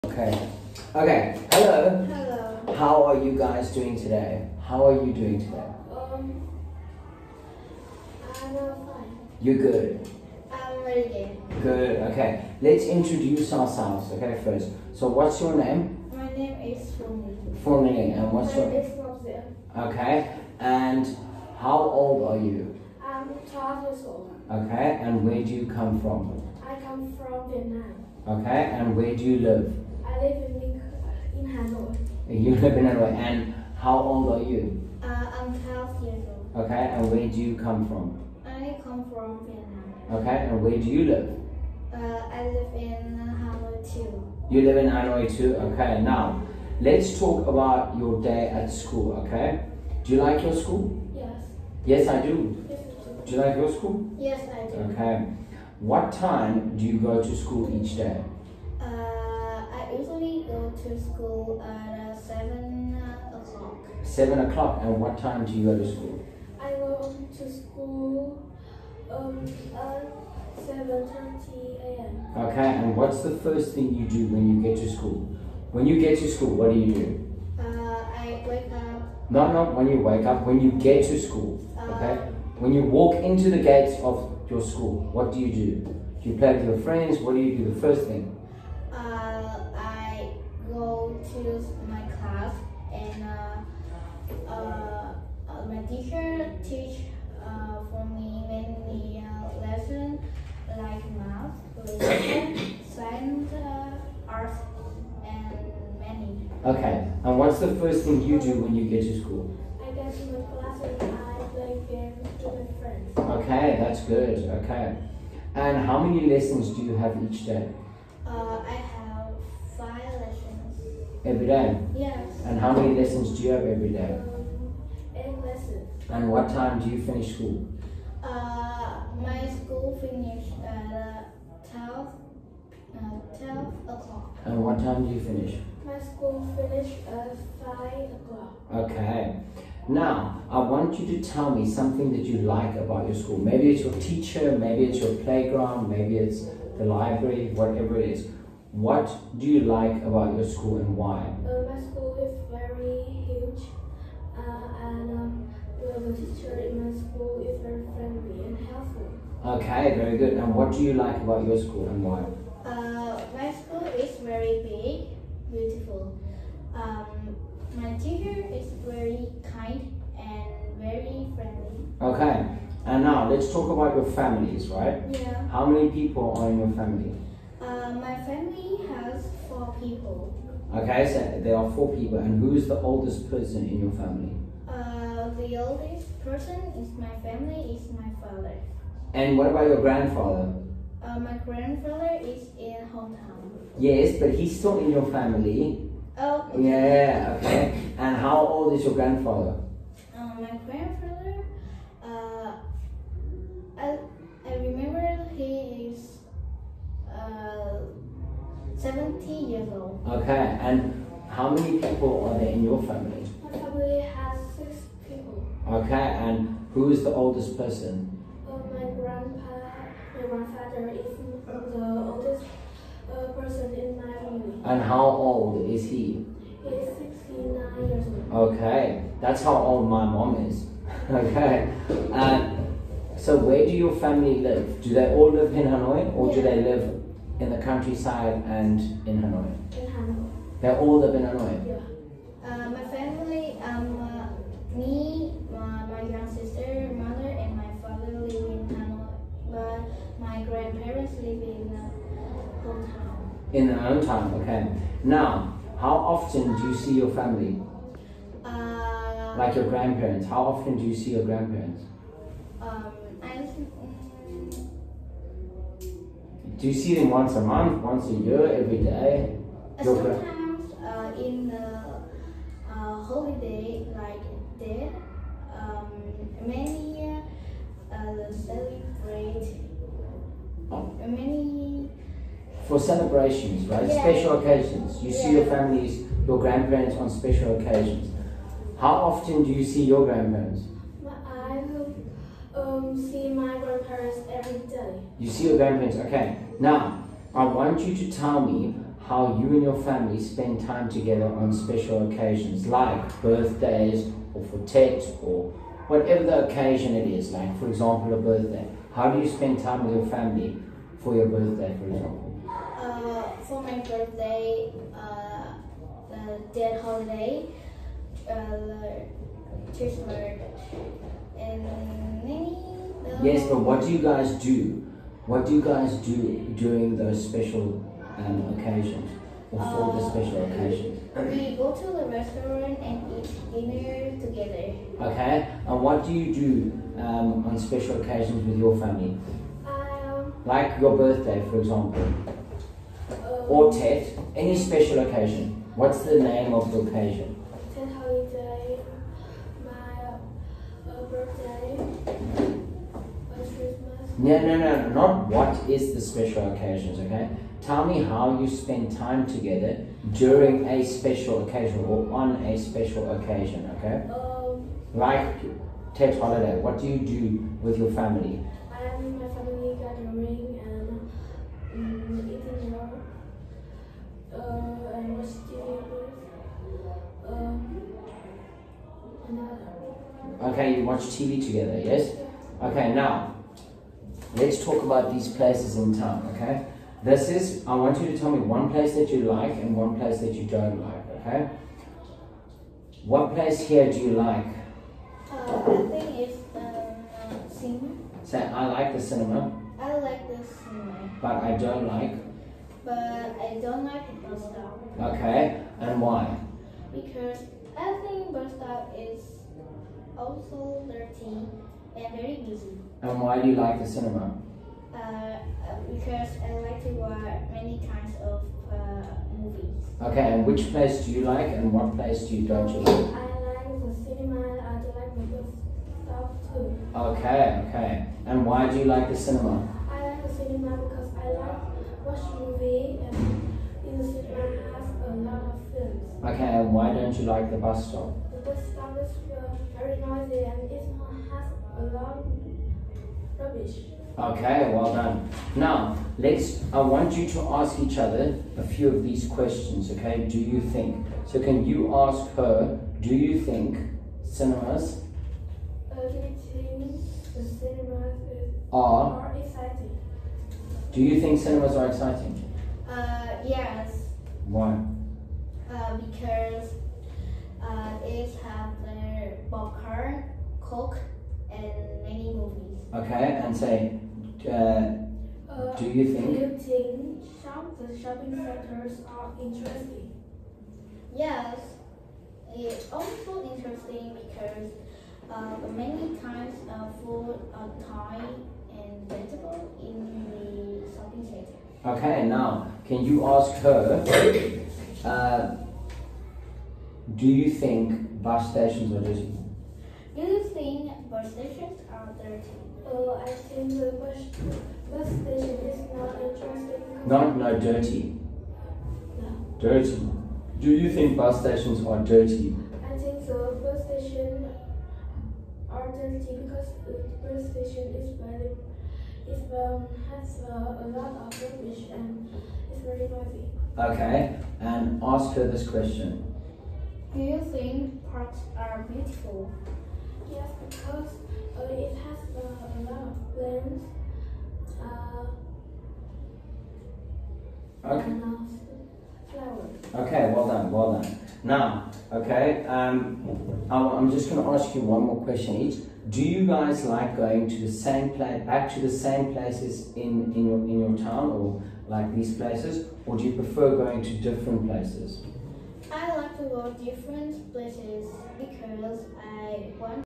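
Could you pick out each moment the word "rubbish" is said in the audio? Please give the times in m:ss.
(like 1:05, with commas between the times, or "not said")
7:23, 8:41.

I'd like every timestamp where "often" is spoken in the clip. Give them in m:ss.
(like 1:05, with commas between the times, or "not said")
4:16, 4:20, 4:49.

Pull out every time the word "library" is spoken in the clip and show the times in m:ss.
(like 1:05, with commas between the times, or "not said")
2:26.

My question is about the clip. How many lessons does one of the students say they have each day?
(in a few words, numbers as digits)
8.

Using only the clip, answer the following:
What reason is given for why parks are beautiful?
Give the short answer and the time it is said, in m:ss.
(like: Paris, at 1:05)
a lot of plants, at 8:52.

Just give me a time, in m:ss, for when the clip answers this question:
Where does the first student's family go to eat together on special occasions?
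5:31.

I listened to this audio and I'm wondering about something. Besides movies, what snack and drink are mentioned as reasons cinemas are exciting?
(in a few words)
popcorn, coke.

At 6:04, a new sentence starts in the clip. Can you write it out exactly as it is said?
Um, like, Tet holiday, what do you do with your family?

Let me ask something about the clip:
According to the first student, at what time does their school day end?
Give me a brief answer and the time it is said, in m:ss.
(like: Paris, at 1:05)
12 o'clock, at 2:13.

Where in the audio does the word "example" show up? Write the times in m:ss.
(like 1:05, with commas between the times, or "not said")
5:07, 5:11, 5:41.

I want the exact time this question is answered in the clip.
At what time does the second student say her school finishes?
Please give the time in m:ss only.
2:17.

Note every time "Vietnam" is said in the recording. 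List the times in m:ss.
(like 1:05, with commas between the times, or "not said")
0:27, 0:39.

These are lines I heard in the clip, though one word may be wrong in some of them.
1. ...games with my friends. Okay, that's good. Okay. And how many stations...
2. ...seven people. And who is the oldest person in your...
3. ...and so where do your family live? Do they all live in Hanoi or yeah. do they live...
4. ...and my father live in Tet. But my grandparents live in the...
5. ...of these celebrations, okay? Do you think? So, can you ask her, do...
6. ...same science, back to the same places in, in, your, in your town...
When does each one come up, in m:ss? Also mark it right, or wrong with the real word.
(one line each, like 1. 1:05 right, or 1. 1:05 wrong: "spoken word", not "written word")
1. 1:51 wrong: "lessons", not "stations"
2. 3:01 wrong: "four", not "seven"
3. 3:52 right
4. 4:07 wrong: "Hanoi", not "Tet"
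5. 7:28 wrong: "questions", not "celebrations"
6. 9:07 wrong: "place", not "science".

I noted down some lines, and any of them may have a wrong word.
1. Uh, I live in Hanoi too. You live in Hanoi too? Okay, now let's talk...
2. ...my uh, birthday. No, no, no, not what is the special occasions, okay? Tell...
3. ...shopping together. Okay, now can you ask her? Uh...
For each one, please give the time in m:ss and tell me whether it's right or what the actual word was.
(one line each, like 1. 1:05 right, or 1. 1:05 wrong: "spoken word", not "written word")
1. 0:41 right
2. 5:49 right
3. 8:10 wrong: "center", not "together".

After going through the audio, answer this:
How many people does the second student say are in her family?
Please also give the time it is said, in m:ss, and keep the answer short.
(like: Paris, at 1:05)
6, at 3:34.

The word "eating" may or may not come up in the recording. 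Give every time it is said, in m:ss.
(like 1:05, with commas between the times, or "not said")
6:12.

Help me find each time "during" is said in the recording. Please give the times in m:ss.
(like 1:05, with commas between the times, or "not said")
5:26, 6:00.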